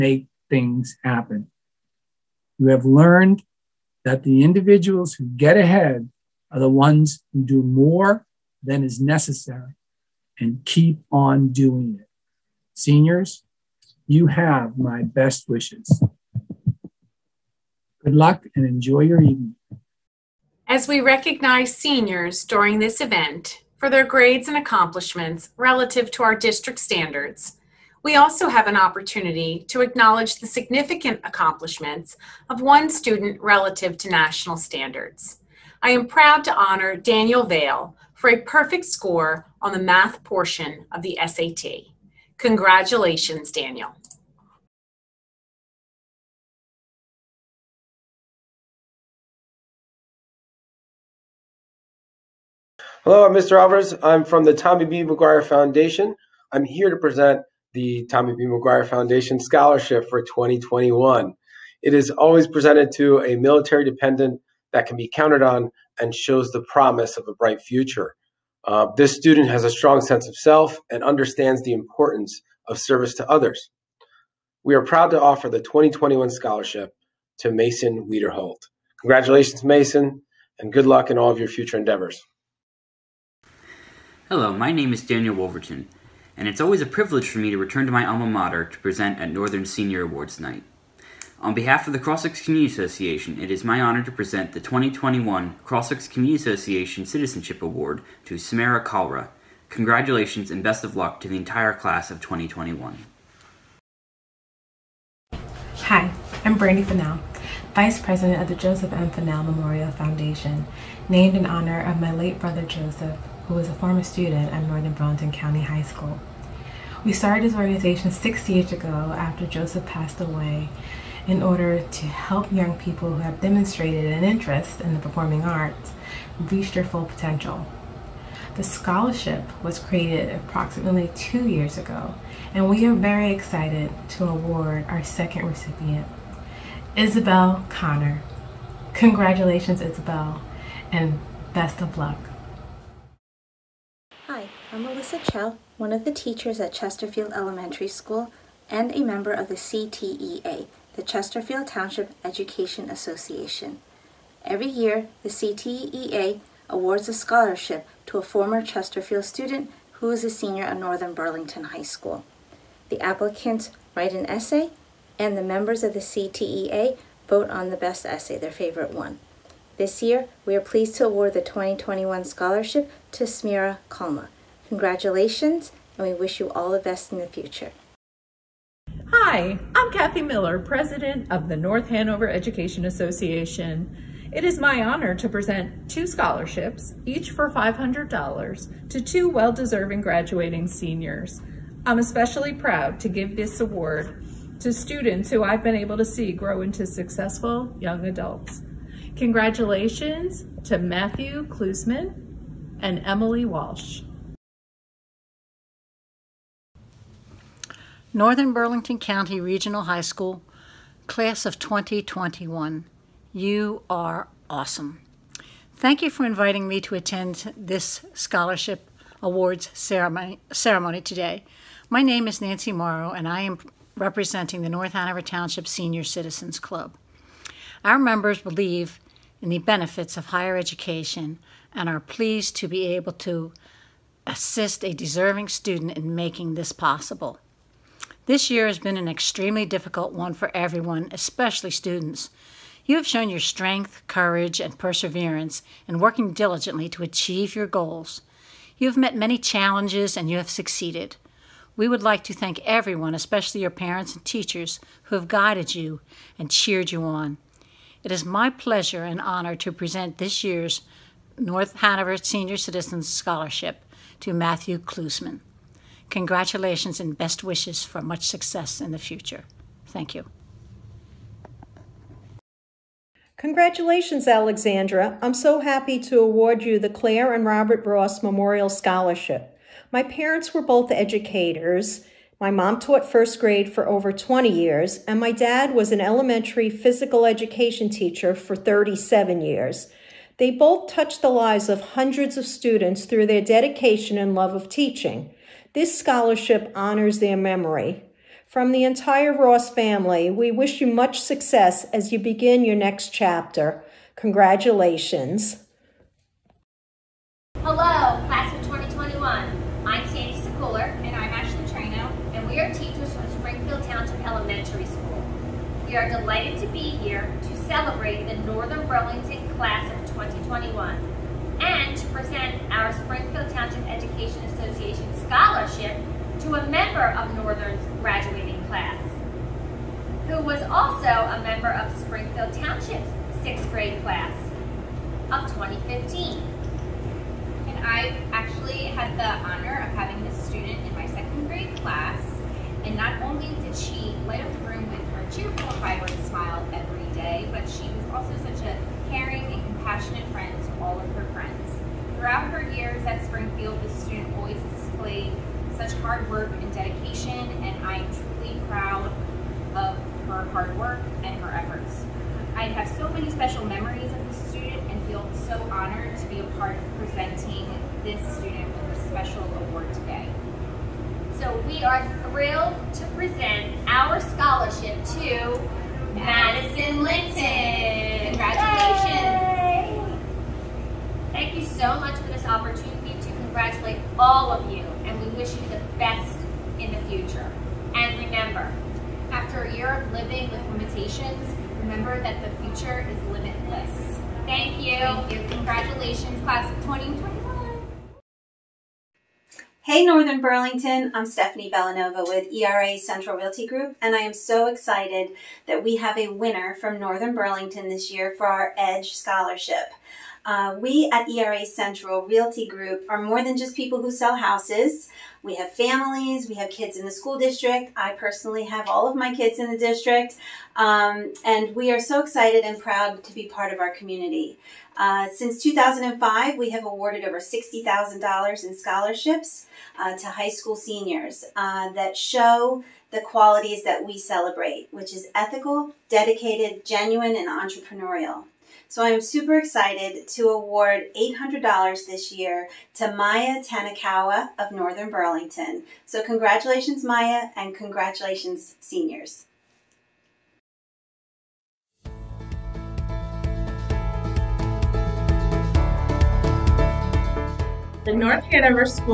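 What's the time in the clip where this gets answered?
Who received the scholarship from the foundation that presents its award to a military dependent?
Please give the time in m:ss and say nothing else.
1:17.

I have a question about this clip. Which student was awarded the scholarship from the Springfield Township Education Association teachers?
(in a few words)
Madison Linton.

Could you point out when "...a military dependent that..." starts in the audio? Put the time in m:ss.
1:03.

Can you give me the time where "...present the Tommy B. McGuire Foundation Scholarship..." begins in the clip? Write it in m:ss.
0:56.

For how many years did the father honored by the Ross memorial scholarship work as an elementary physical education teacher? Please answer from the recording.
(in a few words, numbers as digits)
37.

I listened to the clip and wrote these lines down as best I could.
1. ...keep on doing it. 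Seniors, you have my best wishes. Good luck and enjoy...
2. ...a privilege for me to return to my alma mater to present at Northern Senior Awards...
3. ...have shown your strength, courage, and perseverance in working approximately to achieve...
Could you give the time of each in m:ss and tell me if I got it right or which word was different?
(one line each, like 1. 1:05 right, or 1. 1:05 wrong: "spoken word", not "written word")
1. 0:10 right
2. 1:26 right
3. 4:02 wrong: "diligently", not "approximately".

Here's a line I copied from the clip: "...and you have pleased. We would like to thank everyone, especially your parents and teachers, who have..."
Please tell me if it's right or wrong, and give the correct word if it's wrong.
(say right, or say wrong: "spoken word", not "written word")
wrong: "succeeded", not "pleased".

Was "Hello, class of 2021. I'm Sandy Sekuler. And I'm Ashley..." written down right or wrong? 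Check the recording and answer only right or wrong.
right.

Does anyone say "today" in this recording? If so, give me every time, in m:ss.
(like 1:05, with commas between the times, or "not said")
3:41, 6:09.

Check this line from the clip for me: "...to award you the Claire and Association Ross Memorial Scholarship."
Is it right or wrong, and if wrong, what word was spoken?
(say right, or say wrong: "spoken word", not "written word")
wrong: "Robert", not "Association".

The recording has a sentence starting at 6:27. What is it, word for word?
And remember, after a year of living with limitations, remember that the future is limitless.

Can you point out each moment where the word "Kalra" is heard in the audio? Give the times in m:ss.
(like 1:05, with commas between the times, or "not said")
1:38, 2:53.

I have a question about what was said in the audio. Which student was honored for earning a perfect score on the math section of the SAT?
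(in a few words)
Daniel Vale.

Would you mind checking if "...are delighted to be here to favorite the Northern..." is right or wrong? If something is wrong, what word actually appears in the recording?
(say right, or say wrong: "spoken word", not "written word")
wrong: "celebrate", not "favorite".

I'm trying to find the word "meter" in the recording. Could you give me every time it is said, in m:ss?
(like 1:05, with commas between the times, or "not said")
not said.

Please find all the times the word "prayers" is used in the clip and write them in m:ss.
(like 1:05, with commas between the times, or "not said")
not said.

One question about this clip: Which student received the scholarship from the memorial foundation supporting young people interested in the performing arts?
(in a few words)
Isabel Connor.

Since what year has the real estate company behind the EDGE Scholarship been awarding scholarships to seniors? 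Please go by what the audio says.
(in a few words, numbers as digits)
2005.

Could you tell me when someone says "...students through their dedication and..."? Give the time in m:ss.
4:52.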